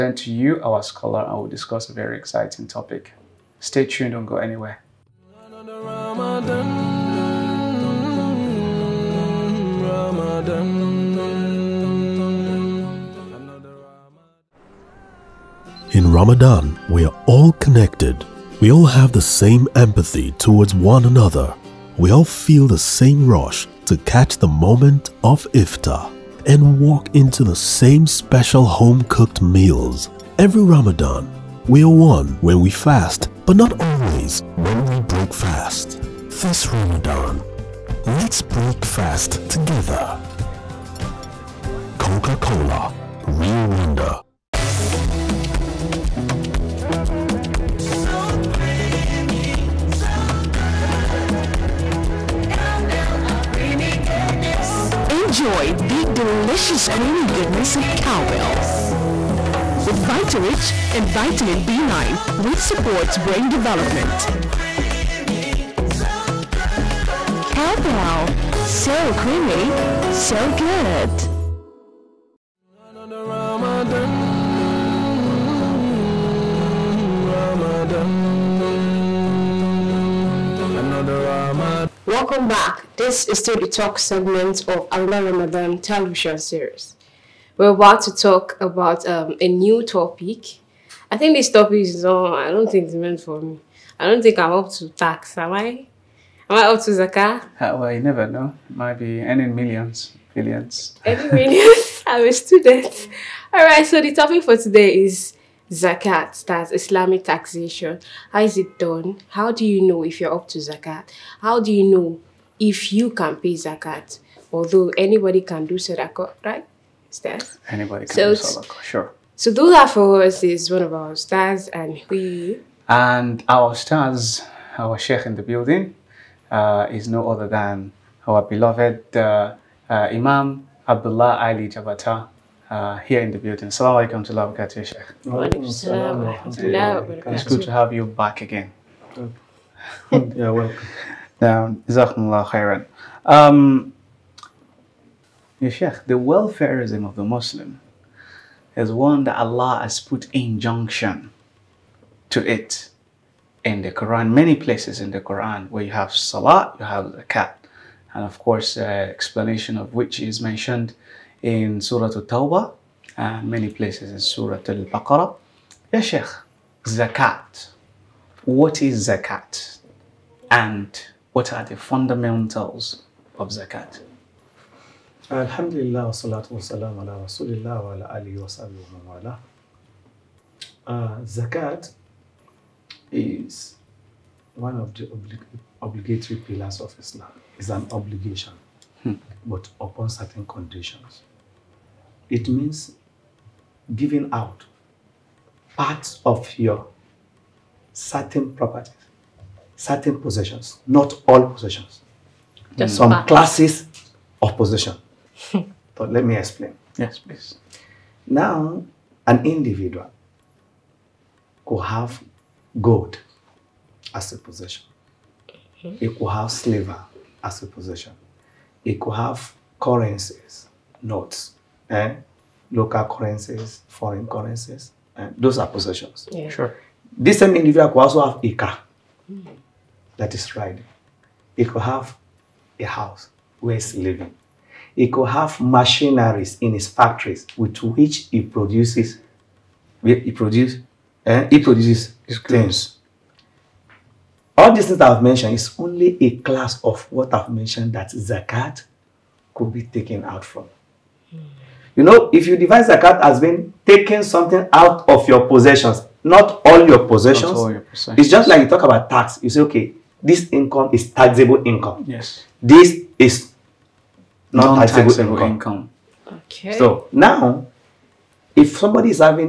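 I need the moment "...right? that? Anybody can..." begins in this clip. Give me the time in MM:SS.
01:56.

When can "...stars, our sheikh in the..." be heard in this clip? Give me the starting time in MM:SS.
02:03.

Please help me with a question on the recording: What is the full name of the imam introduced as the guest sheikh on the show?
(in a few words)
Abdullah Ali Jabata.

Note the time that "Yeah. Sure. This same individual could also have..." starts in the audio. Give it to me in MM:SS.
03:46.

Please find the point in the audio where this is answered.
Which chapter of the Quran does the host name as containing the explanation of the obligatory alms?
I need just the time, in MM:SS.
02:41.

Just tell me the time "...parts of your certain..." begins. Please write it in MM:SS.
03:15.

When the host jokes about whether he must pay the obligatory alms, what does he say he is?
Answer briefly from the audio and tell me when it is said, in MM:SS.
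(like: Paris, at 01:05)
A student, at 01:42.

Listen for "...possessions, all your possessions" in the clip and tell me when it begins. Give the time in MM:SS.
04:17.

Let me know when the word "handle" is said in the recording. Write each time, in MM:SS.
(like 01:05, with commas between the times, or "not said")
not said.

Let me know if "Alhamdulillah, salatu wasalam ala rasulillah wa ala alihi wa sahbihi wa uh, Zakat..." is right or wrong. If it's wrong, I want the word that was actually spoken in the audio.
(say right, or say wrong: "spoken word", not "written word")
right.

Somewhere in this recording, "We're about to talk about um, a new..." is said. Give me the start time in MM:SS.
01:27.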